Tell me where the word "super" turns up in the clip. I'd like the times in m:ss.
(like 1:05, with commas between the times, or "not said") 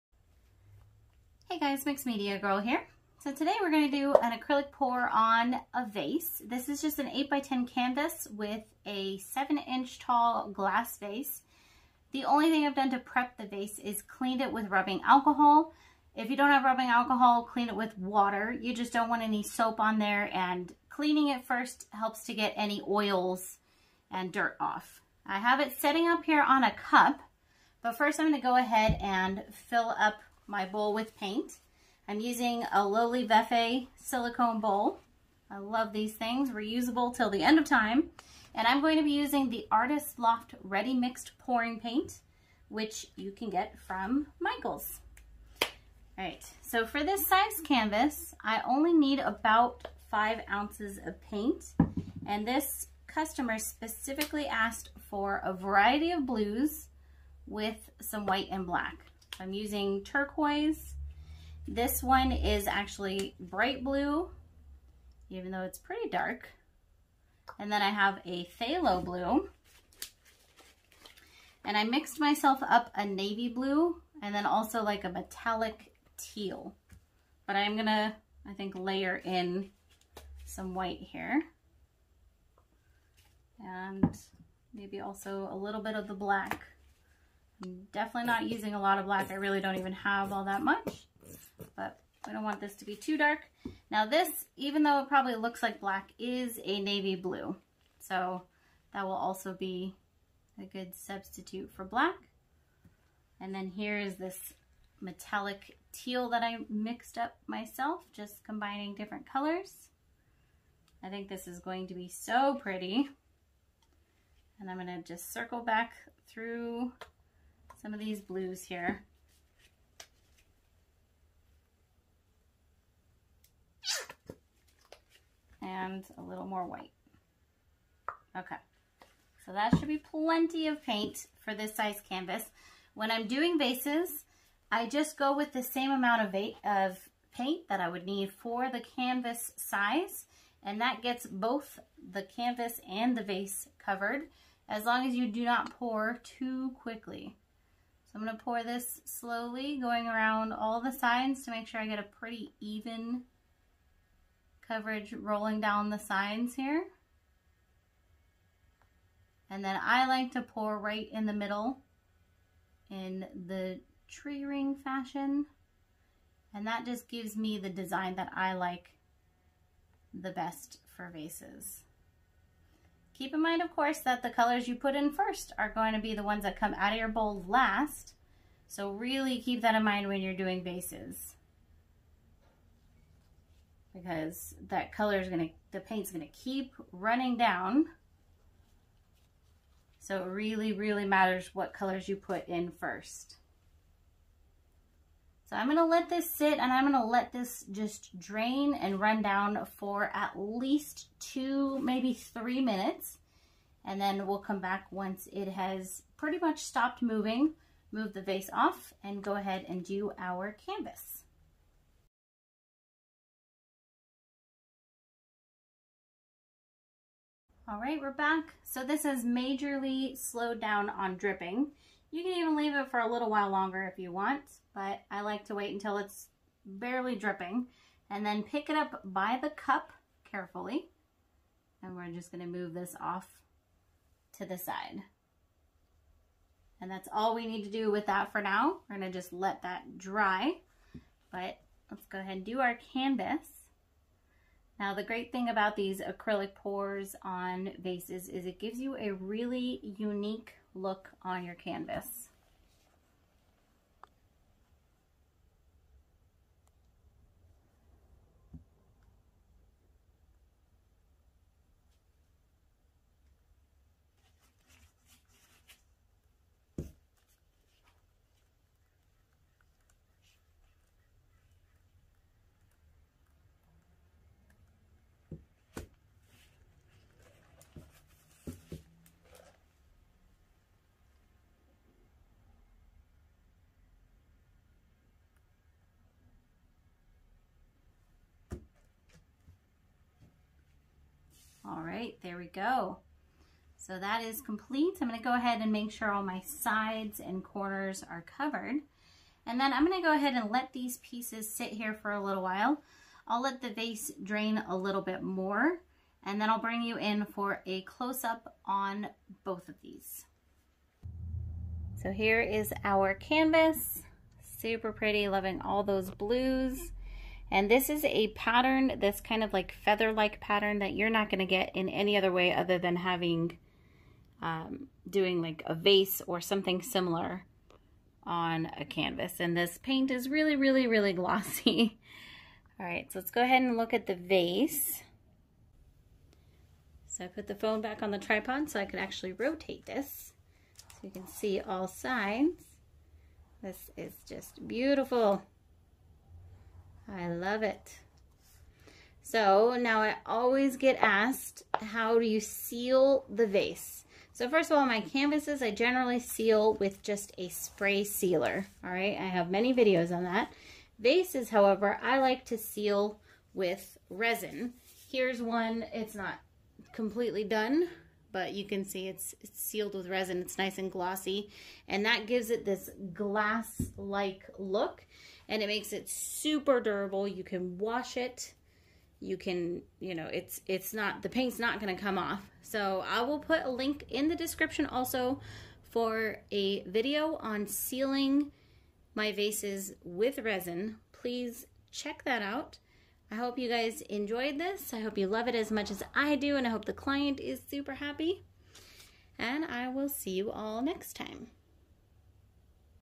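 5:14, 6:16, 6:37.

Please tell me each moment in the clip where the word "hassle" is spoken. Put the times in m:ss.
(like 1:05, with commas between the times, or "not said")
not said.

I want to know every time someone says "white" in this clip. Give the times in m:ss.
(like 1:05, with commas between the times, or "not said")
0:58, 1:20, 2:06.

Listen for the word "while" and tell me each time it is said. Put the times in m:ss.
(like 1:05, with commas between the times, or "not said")
3:43, 5:02.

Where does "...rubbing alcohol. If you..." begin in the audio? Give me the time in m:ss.
0:14.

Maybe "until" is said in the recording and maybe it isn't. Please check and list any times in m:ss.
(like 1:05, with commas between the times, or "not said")
3:45.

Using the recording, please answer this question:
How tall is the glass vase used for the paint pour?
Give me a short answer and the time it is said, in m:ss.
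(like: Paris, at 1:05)
7 inches, at 0:09.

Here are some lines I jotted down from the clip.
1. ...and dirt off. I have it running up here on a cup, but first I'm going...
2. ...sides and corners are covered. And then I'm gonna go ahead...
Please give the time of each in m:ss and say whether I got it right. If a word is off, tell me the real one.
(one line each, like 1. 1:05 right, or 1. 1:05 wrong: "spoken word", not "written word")
1. 0:24 wrong: "setting", not "running"
2. 4:56 right.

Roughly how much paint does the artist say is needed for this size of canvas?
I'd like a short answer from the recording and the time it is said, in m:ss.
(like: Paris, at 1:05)
5 ounces, at 0:50.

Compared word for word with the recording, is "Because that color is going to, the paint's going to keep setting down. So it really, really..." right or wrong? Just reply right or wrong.
wrong.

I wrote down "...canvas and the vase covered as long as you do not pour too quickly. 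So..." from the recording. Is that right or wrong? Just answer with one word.
right.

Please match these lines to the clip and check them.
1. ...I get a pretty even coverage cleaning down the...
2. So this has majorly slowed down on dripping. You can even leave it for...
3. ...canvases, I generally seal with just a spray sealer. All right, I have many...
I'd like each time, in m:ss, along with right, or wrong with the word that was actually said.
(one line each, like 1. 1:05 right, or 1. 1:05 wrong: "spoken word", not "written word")
1. 2:31 wrong: "rolling", not "cleaning"
2. 3:38 right
3. 5:55 right.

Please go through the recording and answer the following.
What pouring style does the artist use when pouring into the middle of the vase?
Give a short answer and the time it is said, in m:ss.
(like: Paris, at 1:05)
Tree ring, at 2:44.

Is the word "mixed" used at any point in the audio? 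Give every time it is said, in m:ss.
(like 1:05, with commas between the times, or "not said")
0:01, 0:40, 1:11, 1:46.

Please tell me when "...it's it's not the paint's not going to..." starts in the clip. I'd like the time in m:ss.
6:20.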